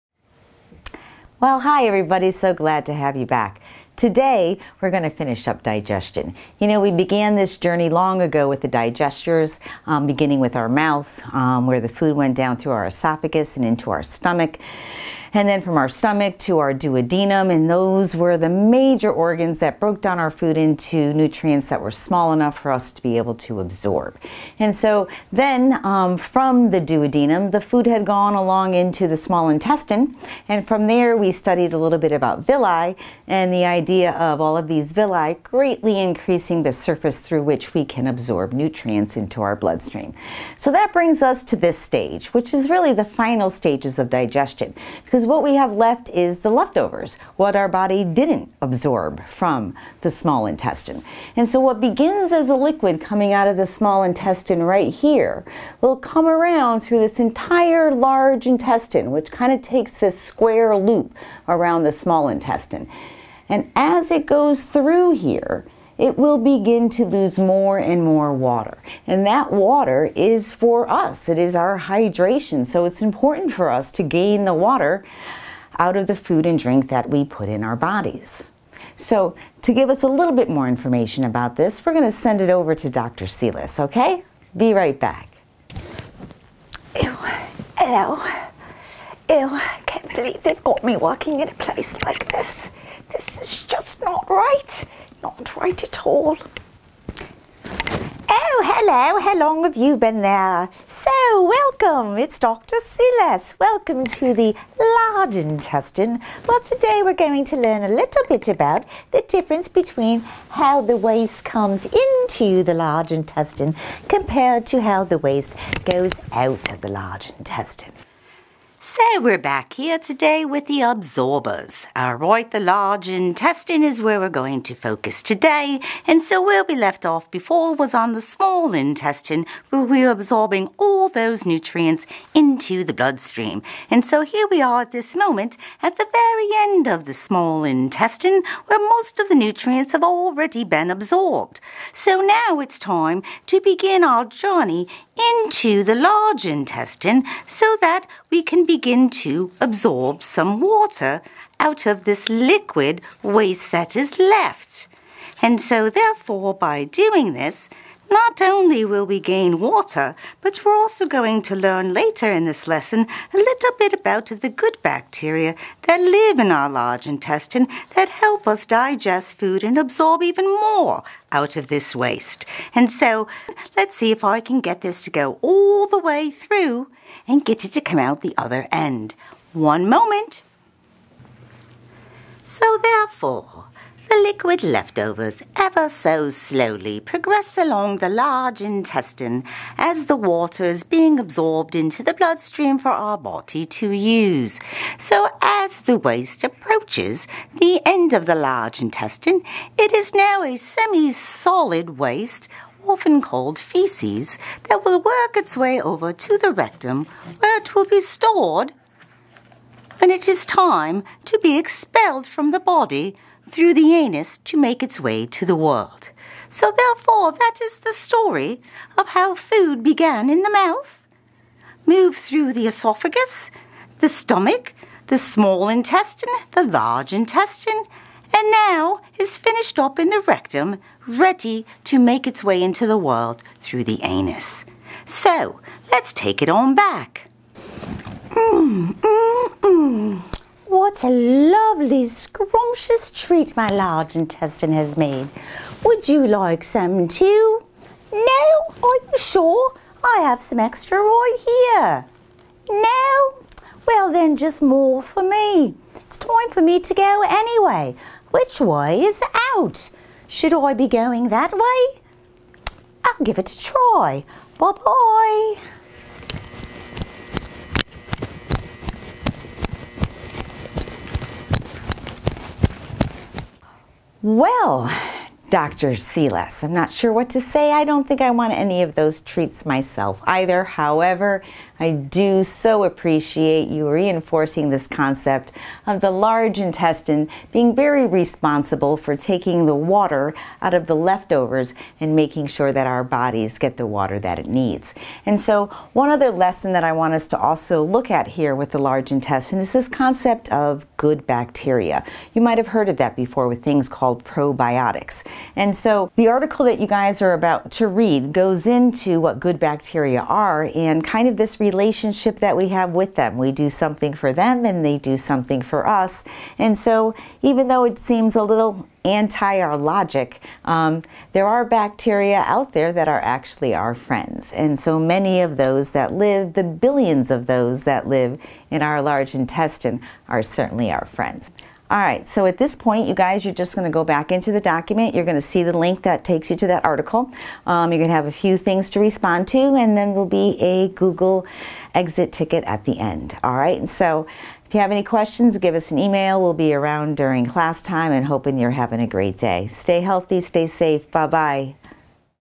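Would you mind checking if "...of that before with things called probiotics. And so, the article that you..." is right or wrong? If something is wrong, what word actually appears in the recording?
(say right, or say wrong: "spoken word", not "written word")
right.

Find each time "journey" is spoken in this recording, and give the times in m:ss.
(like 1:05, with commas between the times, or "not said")
0:07, 2:24.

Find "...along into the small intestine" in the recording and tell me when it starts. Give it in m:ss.
0:28.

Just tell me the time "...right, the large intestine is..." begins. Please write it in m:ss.
2:02.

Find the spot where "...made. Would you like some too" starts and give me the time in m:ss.
4:04.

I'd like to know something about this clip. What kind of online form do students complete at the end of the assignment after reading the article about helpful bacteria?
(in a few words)
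Google exit ticket.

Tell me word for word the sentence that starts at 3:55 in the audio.
So, let's take it on back.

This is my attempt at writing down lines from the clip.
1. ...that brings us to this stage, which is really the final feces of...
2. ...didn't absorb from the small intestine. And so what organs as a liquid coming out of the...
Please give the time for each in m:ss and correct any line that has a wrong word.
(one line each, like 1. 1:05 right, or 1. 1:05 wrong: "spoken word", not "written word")
1. 0:40 wrong: "stages", not "feces"
2. 0:48 wrong: "begins", not "organs".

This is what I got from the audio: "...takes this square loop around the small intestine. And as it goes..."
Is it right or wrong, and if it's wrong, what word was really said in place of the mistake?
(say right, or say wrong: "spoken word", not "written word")
right.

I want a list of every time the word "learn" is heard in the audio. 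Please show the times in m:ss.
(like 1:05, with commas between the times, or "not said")
1:47, 2:41.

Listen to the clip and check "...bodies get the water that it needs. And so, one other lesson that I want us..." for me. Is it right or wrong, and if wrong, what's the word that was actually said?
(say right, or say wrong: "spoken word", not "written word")
right.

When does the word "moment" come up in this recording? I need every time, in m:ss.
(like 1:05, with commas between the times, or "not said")
2:15, 2:59.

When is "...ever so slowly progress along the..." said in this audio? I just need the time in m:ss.
3:05.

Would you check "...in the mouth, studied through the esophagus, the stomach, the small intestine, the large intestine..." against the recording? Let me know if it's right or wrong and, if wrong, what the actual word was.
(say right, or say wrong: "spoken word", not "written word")
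wrong: "moved", not "studied".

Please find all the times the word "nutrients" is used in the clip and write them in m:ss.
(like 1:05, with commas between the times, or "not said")
0:21, 0:38, 2:11, 2:19.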